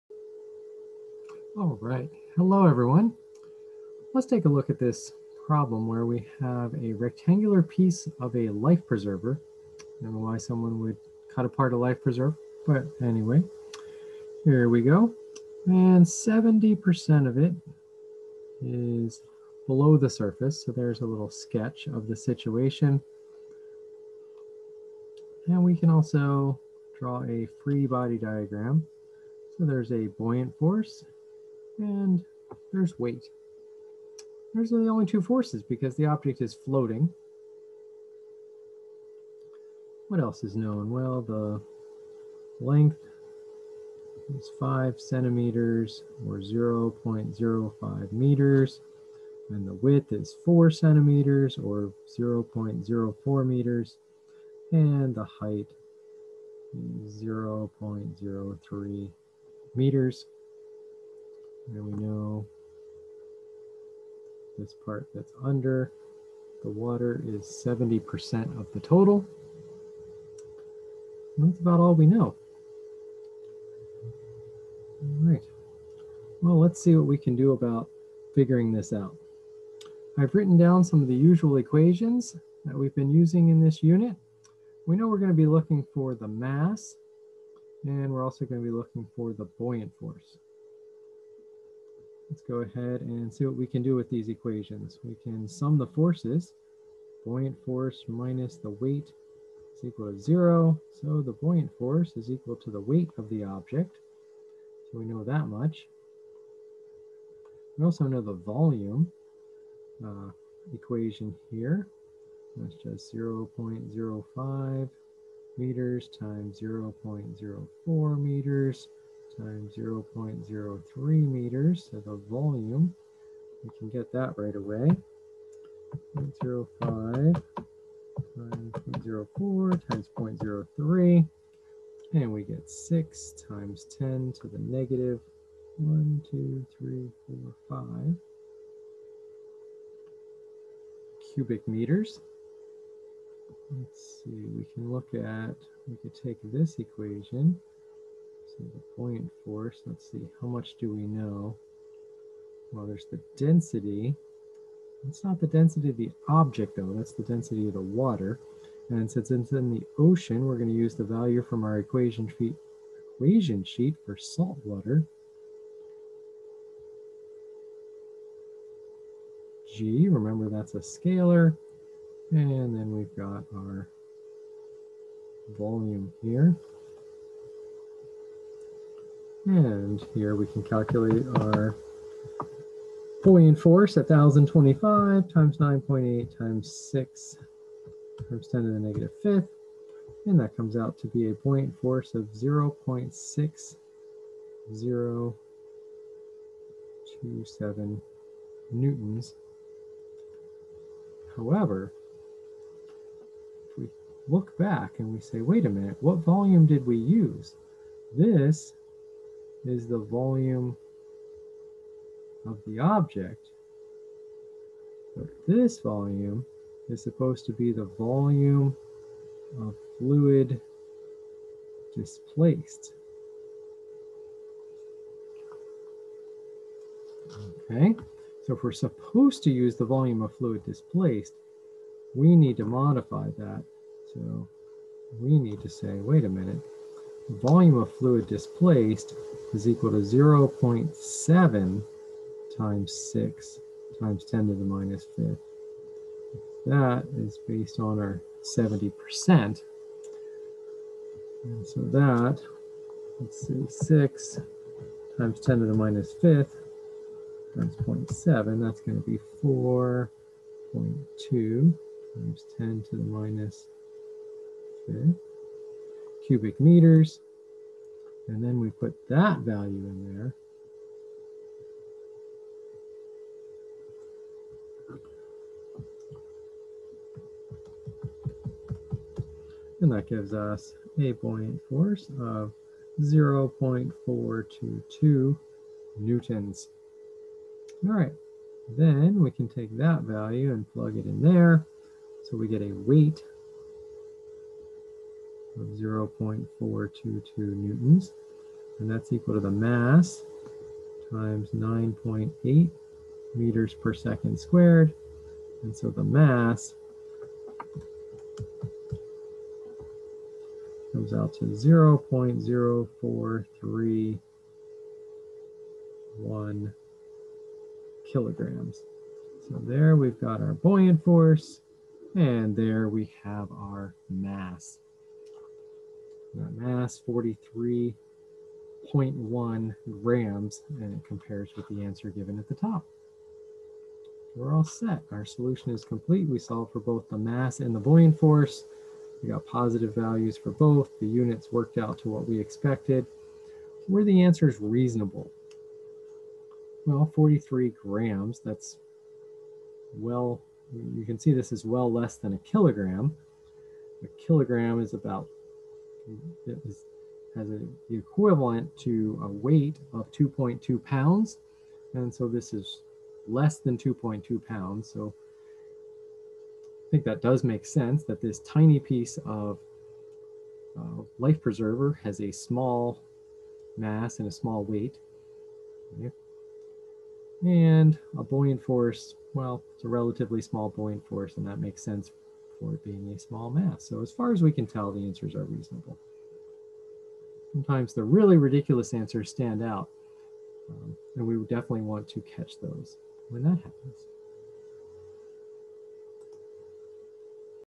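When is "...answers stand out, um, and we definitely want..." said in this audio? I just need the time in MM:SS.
06:28.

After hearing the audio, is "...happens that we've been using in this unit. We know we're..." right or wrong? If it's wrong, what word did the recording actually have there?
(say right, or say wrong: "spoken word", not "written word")
wrong: "equations", not "happens".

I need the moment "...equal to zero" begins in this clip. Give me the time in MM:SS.
01:39.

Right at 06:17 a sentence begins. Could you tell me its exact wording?
And a buoyant force, well, it's a relatively small buoyant force, and that makes sense for it being a small mass.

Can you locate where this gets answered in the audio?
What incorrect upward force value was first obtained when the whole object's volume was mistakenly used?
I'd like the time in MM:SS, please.
03:12.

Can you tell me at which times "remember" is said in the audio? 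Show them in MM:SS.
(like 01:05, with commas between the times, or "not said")
02:50.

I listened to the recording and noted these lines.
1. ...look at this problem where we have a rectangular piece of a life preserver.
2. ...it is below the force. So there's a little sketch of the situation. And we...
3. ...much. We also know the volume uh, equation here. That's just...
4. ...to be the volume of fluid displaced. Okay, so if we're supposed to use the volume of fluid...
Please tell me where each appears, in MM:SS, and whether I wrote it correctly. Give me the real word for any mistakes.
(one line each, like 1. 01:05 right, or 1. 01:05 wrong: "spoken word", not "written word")
1. 00:04 right
2. 00:17 wrong: "surface", not "force"
3. 01:45 right
4. 03:37 right.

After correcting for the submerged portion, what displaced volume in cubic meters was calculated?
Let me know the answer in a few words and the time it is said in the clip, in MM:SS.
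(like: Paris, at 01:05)
4.2 x 10^-5 cubic meters, at 04:19.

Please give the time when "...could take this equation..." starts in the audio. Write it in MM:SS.
02:26.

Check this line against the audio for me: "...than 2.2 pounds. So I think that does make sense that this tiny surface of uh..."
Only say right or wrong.
wrong.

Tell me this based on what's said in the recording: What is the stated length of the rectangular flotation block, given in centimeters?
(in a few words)
5 centimeters.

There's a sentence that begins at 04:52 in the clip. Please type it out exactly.
So we get a weight of 0.422 newtons.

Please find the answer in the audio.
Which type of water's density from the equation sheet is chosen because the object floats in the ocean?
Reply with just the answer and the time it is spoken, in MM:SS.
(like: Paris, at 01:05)
salt water, at 02:44.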